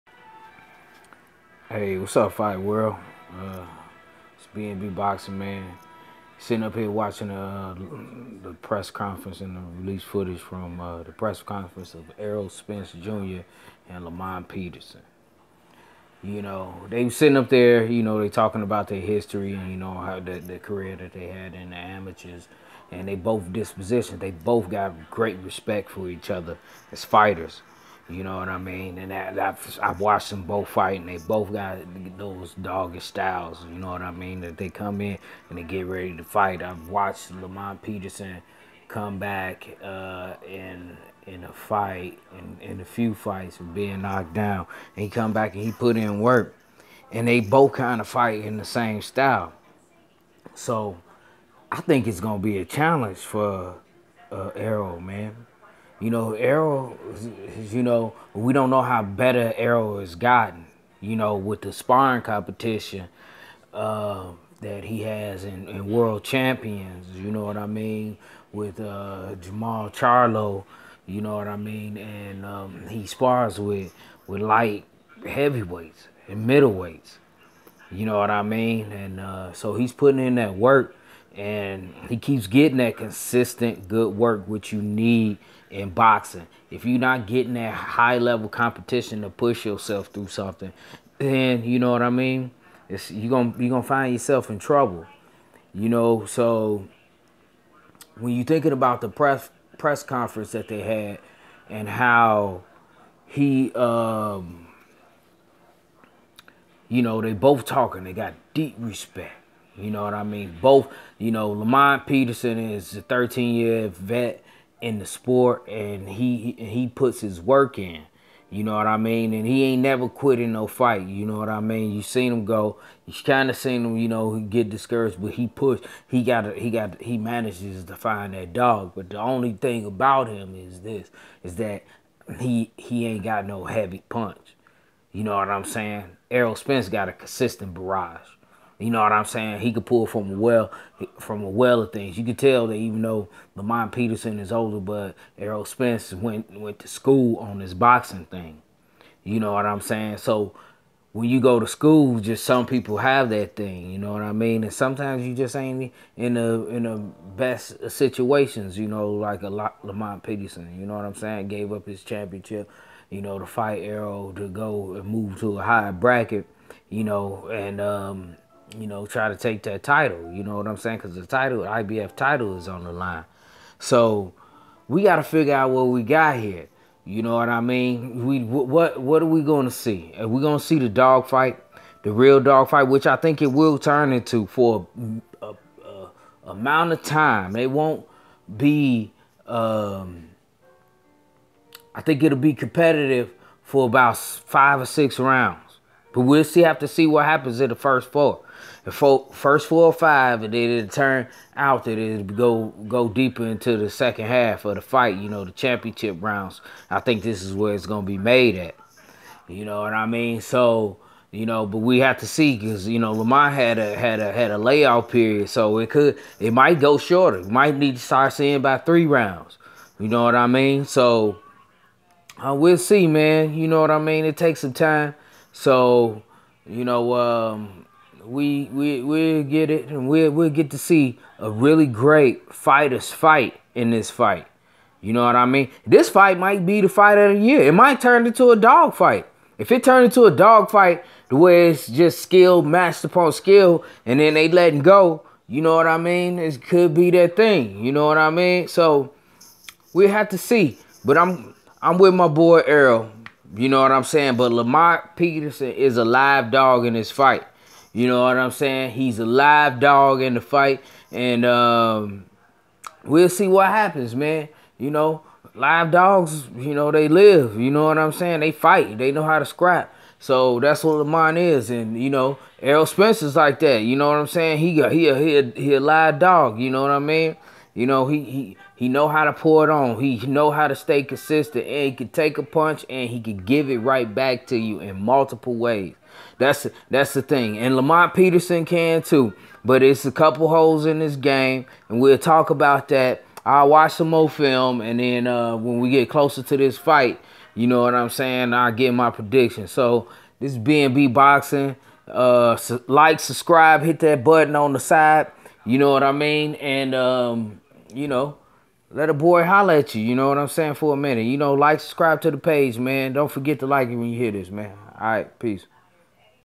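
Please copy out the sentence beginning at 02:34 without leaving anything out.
And sometimes you just ain't in the in the best situations.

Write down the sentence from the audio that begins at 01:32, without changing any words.
It's, you're gonna you're gonna find yourself in trouble, you know.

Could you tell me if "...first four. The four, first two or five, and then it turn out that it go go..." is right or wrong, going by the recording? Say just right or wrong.
wrong.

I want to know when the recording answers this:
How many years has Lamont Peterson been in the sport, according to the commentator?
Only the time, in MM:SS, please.
01:53.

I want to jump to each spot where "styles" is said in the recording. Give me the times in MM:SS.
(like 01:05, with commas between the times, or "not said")
00:32, 00:49.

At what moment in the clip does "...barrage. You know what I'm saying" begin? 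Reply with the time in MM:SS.
02:17.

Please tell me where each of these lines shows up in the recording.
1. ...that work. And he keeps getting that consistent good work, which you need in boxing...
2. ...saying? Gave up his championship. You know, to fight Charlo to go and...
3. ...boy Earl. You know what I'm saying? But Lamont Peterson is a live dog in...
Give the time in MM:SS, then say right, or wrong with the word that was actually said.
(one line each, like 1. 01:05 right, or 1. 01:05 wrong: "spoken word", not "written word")
1. 01:20 right
2. 02:41 wrong: "Errol", not "Charlo"
3. 04:12 right.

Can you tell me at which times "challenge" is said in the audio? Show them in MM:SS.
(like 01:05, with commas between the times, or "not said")
00:52.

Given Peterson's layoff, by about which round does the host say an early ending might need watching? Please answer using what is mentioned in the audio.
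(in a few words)
3.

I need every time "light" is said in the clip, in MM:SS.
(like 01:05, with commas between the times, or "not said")
01:14.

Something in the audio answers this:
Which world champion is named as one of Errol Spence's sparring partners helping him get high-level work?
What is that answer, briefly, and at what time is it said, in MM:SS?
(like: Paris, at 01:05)
Jermall Charlo, at 01:09.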